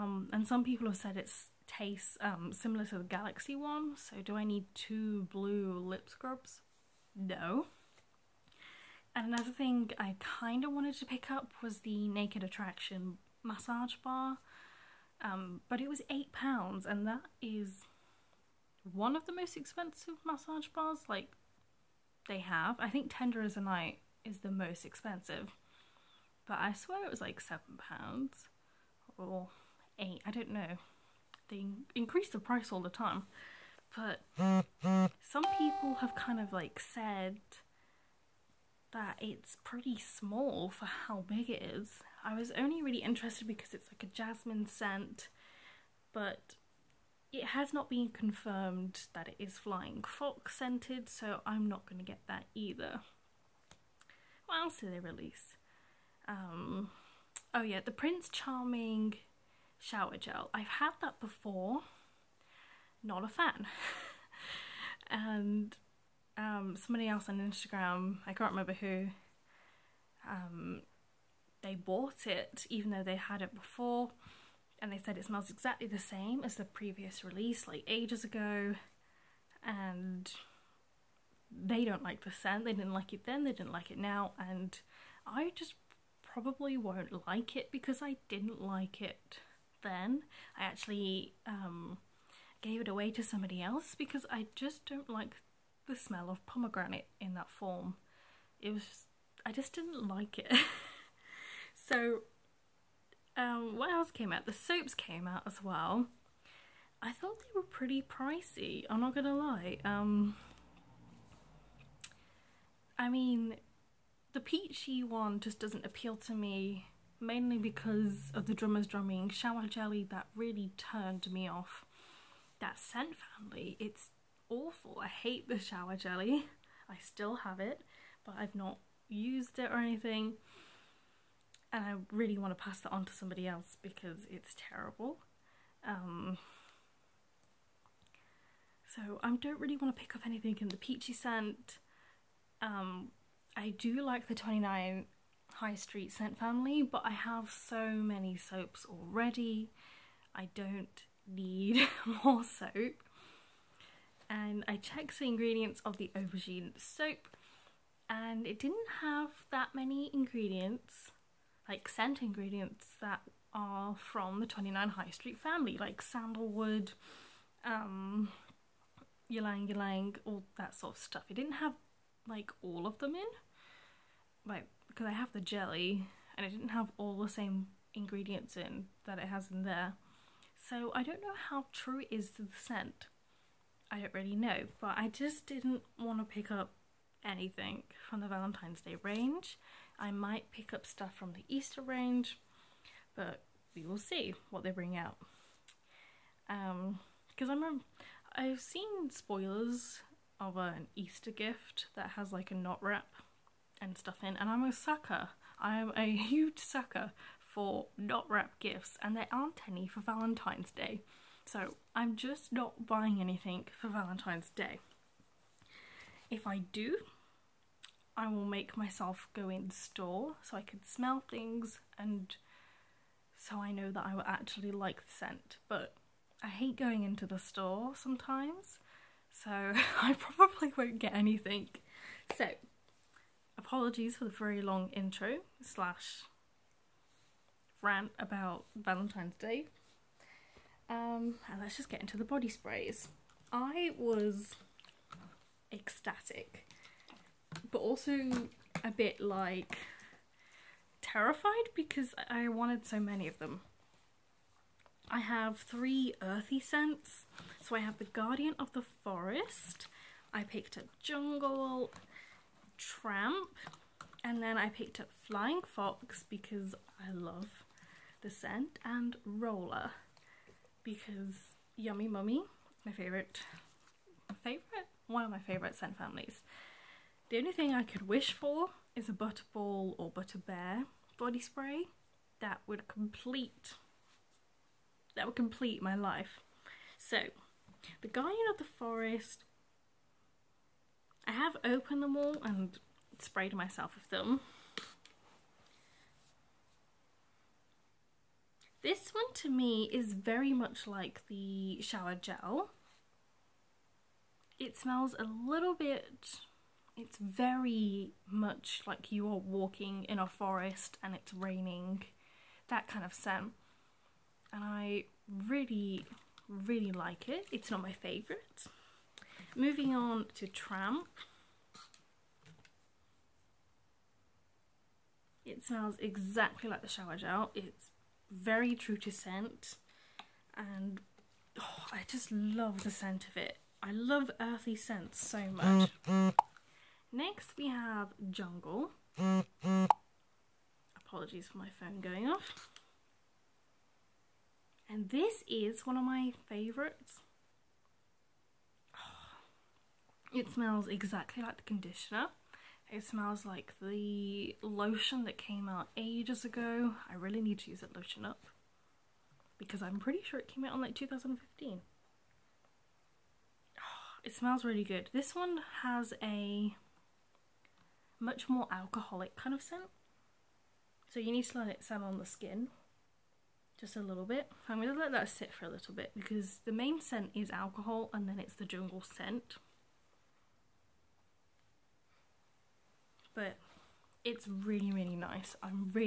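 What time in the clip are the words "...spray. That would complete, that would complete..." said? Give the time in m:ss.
4:41.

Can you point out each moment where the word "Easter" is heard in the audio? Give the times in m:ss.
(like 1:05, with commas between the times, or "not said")
3:11, 3:20.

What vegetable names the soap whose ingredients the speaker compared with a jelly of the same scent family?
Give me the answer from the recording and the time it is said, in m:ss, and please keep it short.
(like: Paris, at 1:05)
aubergine, at 2:36.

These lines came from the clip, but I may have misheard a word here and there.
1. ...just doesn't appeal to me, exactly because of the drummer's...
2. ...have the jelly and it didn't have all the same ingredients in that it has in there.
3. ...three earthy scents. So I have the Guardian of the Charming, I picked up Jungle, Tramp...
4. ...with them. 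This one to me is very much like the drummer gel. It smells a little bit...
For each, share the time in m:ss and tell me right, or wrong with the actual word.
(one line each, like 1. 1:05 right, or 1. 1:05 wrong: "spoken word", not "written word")
1. 1:55 wrong: "mainly", not "exactly"
2. 2:55 right
3. 4:15 wrong: "Forest", not "Charming"
4. 4:53 wrong: "shower", not "drummer".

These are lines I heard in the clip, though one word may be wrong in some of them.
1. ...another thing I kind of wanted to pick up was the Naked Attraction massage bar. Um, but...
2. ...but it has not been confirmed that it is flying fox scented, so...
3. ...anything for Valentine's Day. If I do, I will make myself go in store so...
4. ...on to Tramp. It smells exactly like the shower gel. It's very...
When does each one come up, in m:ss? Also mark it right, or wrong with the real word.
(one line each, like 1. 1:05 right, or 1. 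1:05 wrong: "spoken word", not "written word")
1. 0:09 right
2. 0:46 right
3. 3:33 right
4. 5:19 right.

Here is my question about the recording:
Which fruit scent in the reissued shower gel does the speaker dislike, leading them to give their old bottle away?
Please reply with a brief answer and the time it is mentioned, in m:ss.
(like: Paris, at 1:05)
pomegranate, at 1:36.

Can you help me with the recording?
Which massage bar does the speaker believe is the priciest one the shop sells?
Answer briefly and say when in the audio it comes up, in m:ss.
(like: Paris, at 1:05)
Tender is the Night, at 0:23.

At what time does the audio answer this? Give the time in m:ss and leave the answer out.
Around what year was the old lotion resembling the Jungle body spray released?
6:00.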